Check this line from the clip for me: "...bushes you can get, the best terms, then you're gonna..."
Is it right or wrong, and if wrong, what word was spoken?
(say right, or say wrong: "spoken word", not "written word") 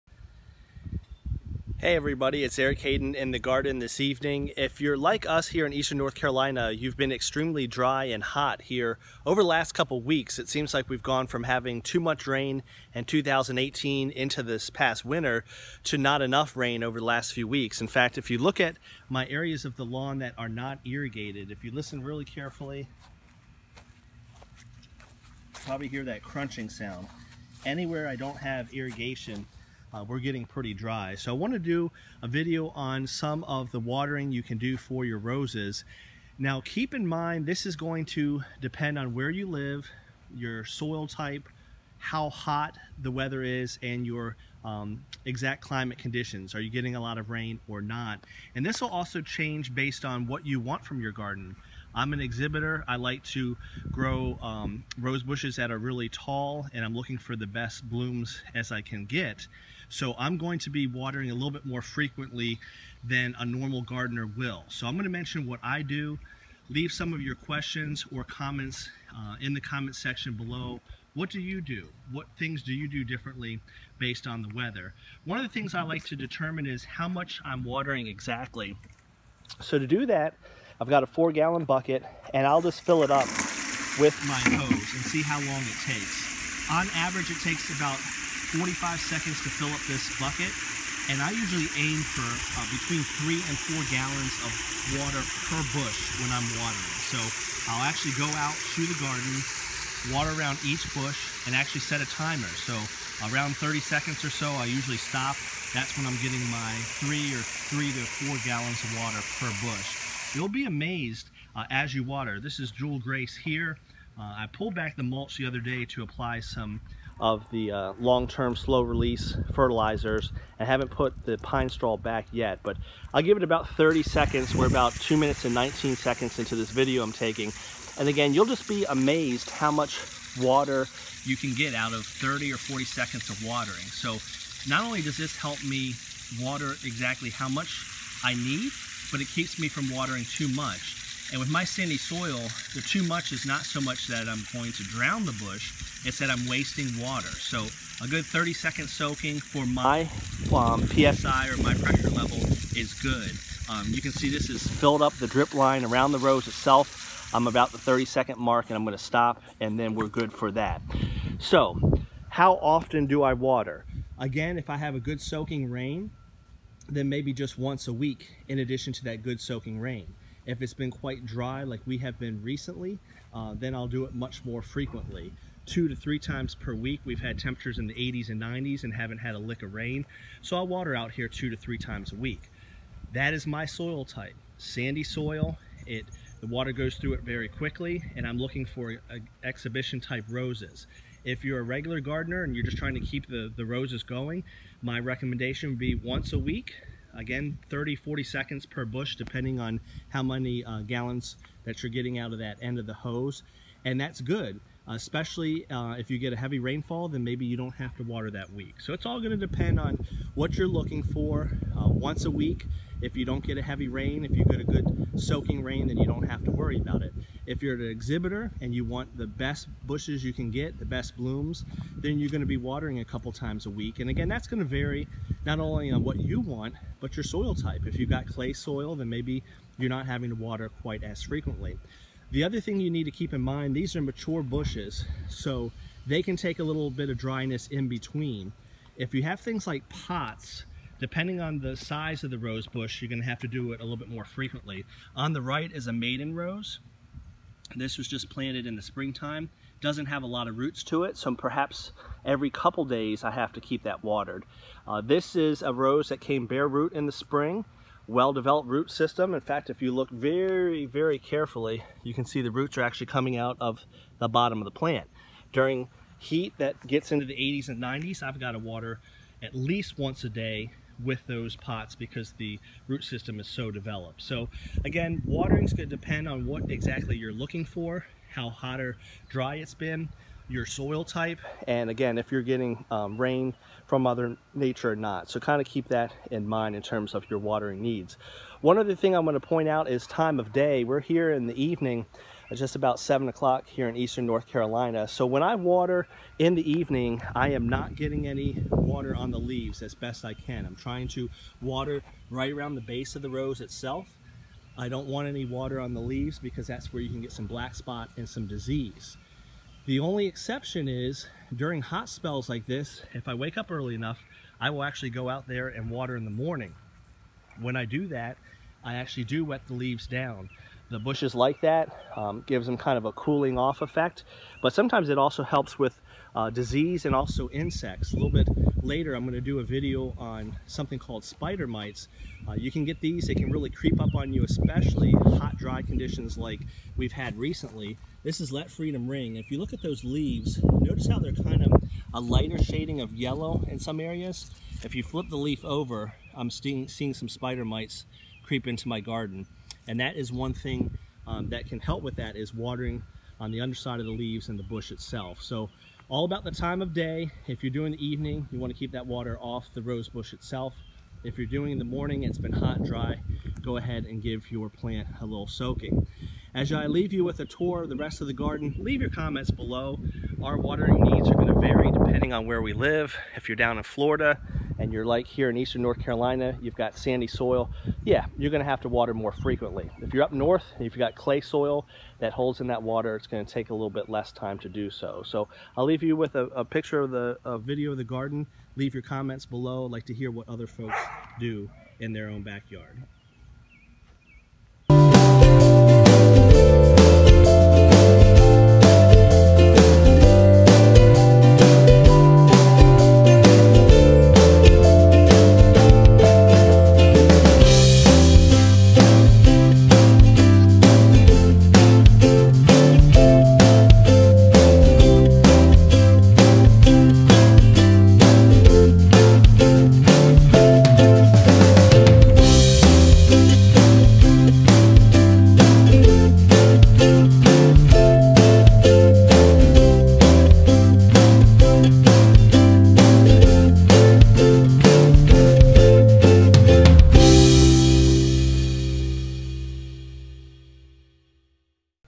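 wrong: "blooms", not "terms".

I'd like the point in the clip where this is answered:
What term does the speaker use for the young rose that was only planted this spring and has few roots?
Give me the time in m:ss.
4:05.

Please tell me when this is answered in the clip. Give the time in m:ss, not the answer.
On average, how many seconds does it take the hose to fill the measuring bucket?
1:28.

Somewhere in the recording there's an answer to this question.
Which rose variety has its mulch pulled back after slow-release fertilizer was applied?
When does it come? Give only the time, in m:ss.
1:52.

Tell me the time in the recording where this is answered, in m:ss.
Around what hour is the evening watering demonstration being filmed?
4:52.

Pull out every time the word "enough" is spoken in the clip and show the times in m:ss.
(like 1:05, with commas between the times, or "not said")
0:16, 5:13.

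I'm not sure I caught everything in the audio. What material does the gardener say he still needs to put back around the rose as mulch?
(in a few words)
Pine straw.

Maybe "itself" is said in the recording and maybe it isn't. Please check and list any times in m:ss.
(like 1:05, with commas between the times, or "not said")
2:36, 5:03, 5:54, 6:00.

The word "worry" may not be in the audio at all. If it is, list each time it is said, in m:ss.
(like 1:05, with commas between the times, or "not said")
3:36.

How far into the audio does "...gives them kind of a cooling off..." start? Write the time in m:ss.
5:22.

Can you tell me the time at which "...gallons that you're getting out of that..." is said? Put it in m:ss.
3:20.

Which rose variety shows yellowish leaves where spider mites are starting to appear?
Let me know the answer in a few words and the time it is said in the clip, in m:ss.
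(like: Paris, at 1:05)
Let Freedom Ring, at 5:38.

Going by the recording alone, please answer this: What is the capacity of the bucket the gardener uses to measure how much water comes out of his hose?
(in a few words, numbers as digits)
4 gallons.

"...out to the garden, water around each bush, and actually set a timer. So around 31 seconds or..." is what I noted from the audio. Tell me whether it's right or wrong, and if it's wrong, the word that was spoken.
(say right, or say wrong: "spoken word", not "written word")
wrong: "30", not "31".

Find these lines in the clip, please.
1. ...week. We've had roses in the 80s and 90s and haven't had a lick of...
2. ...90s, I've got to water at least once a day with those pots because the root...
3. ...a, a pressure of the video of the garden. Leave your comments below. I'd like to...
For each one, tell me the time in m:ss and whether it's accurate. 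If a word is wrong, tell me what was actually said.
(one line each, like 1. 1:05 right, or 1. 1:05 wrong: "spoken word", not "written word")
1. 2:56 wrong: "temperatures", not "roses"
2. 4:27 right
3. 6:26 wrong: "picture", not "pressure".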